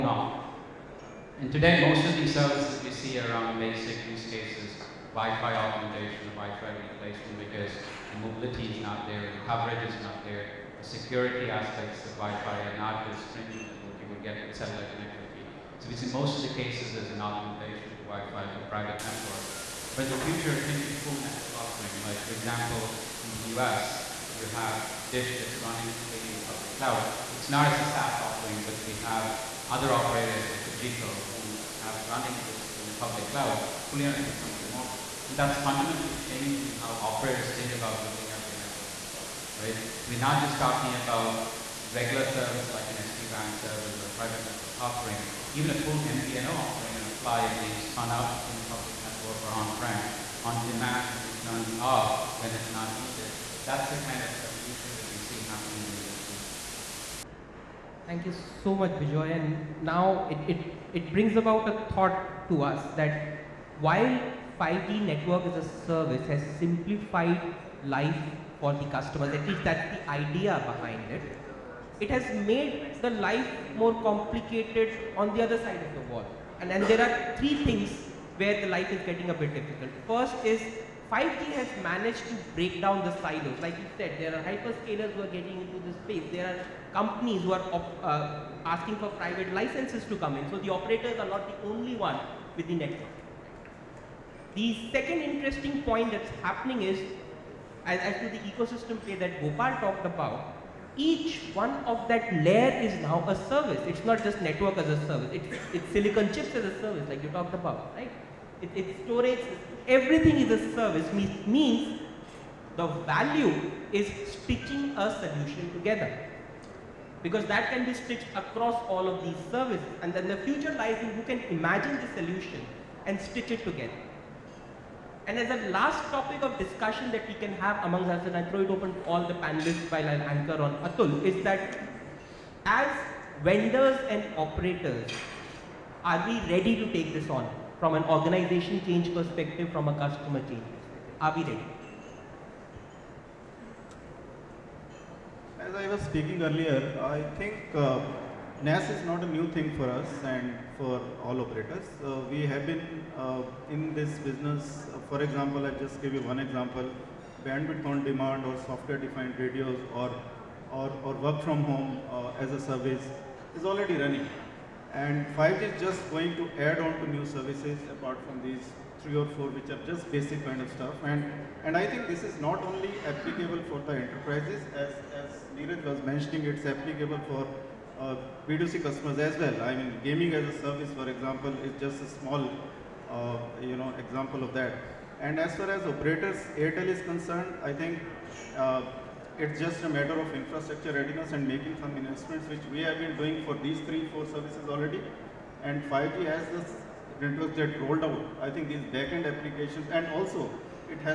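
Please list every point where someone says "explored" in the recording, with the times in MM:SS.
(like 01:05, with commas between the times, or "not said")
not said.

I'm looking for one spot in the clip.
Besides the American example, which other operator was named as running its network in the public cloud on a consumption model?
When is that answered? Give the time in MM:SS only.
00:30.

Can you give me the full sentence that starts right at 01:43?
It's not just network as a service.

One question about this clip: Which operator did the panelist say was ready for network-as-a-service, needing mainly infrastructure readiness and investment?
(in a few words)
Airtel.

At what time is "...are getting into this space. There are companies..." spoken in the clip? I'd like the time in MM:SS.
01:25.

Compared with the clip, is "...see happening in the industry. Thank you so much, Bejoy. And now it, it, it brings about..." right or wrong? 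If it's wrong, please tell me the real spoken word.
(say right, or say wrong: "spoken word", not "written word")
right.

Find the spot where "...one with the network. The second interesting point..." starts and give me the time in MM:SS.
01:31.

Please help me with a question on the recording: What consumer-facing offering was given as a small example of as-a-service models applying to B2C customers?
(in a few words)
Gaming as a service.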